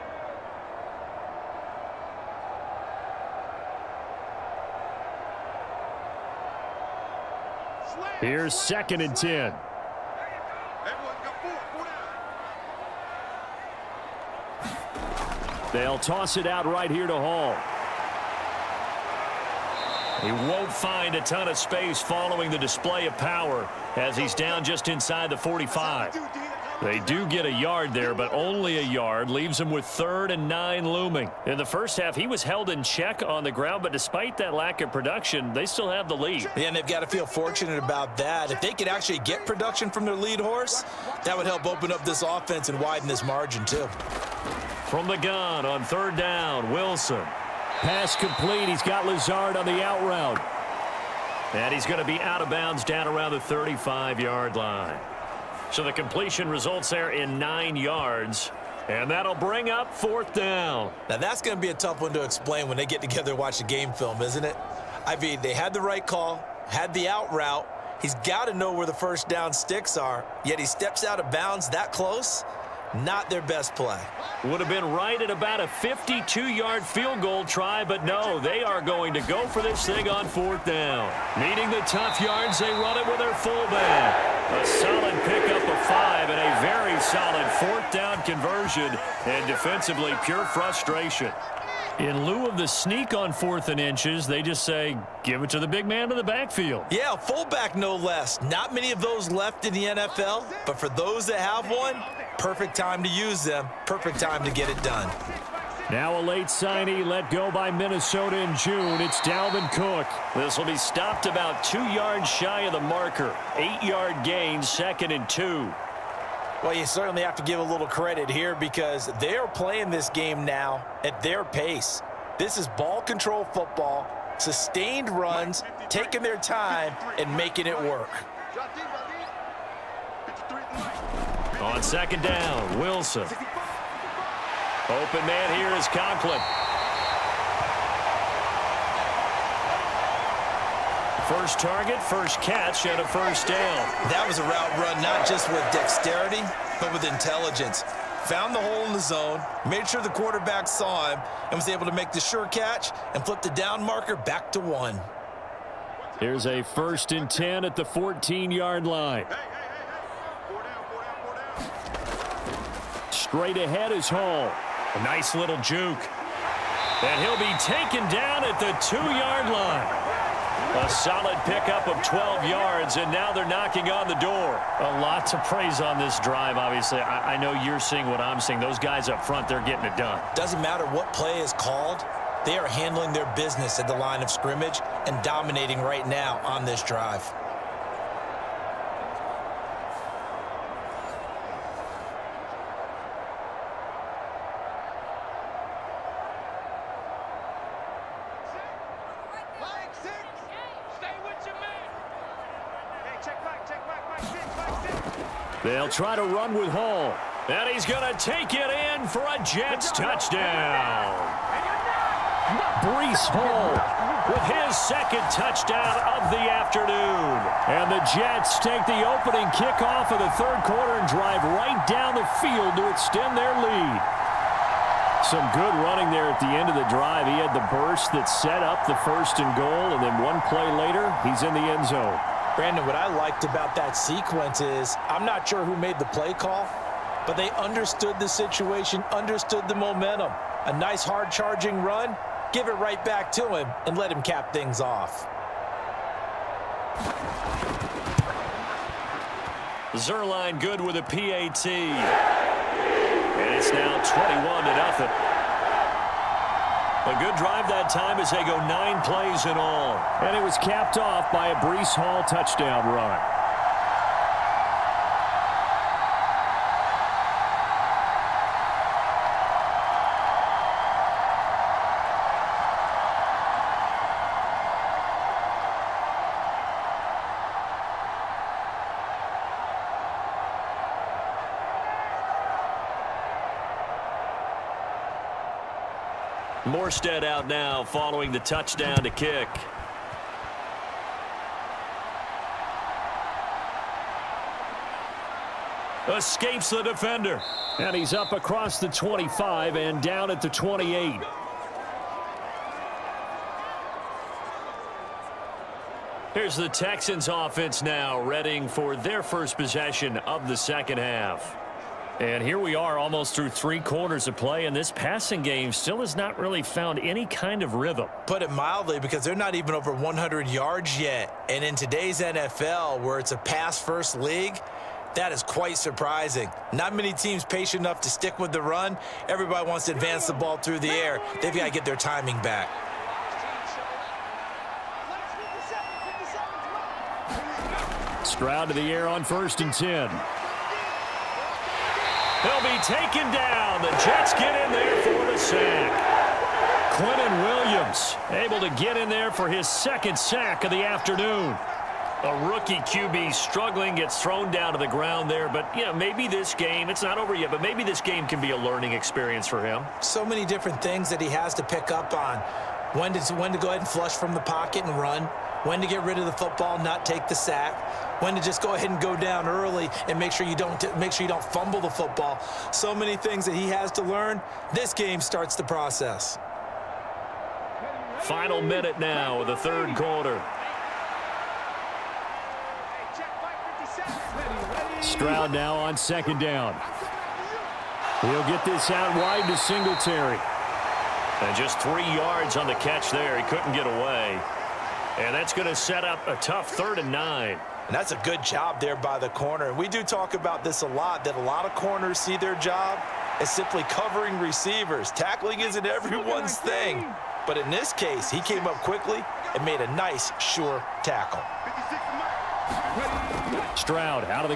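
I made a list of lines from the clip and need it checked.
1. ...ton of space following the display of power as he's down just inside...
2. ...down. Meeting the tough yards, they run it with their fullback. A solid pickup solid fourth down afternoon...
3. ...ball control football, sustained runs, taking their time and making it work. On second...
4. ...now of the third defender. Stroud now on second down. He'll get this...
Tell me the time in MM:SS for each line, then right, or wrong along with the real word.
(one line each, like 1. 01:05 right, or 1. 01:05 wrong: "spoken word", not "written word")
1. 00:21 right
2. 01:20 wrong: "conversion", not "afternoon"
3. 02:02 right
4. 06:18 wrong: "quarter", not "defender".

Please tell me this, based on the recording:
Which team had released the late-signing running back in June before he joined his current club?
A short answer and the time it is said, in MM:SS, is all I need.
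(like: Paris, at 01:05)
Minnesota, at 01:47.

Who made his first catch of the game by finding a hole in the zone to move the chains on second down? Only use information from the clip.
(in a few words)
Conklin.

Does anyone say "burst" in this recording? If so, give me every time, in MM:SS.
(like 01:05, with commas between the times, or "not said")
03:47.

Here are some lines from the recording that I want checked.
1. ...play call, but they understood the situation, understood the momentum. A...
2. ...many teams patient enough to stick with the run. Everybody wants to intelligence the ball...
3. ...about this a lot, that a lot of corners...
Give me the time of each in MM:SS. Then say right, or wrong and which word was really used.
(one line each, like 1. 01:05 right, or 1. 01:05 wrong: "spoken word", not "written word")
1. 03:56 right
2. 05:26 wrong: "advance", not "intelligence"
3. 06:40 right.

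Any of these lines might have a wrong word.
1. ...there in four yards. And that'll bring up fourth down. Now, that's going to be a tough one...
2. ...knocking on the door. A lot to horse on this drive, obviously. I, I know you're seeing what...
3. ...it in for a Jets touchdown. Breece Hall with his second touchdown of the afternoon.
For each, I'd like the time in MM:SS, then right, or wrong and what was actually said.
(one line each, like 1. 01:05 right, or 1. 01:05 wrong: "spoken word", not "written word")
1. 00:56 wrong: "nine", not "four"
2. 02:53 wrong: "praise", not "horse"
3. 03:28 right.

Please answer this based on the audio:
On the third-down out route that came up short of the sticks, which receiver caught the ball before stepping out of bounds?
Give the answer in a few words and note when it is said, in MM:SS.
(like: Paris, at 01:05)
Lazard, at 00:49.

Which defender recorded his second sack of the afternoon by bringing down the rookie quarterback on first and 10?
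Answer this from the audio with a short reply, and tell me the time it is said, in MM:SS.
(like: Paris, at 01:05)
Quinnen Williams, at 05:46.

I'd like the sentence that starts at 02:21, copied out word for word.
First target, first catch, and a first down.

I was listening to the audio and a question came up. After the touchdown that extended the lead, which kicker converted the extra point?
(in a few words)
Zuerlein.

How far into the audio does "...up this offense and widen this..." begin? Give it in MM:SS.
00:41.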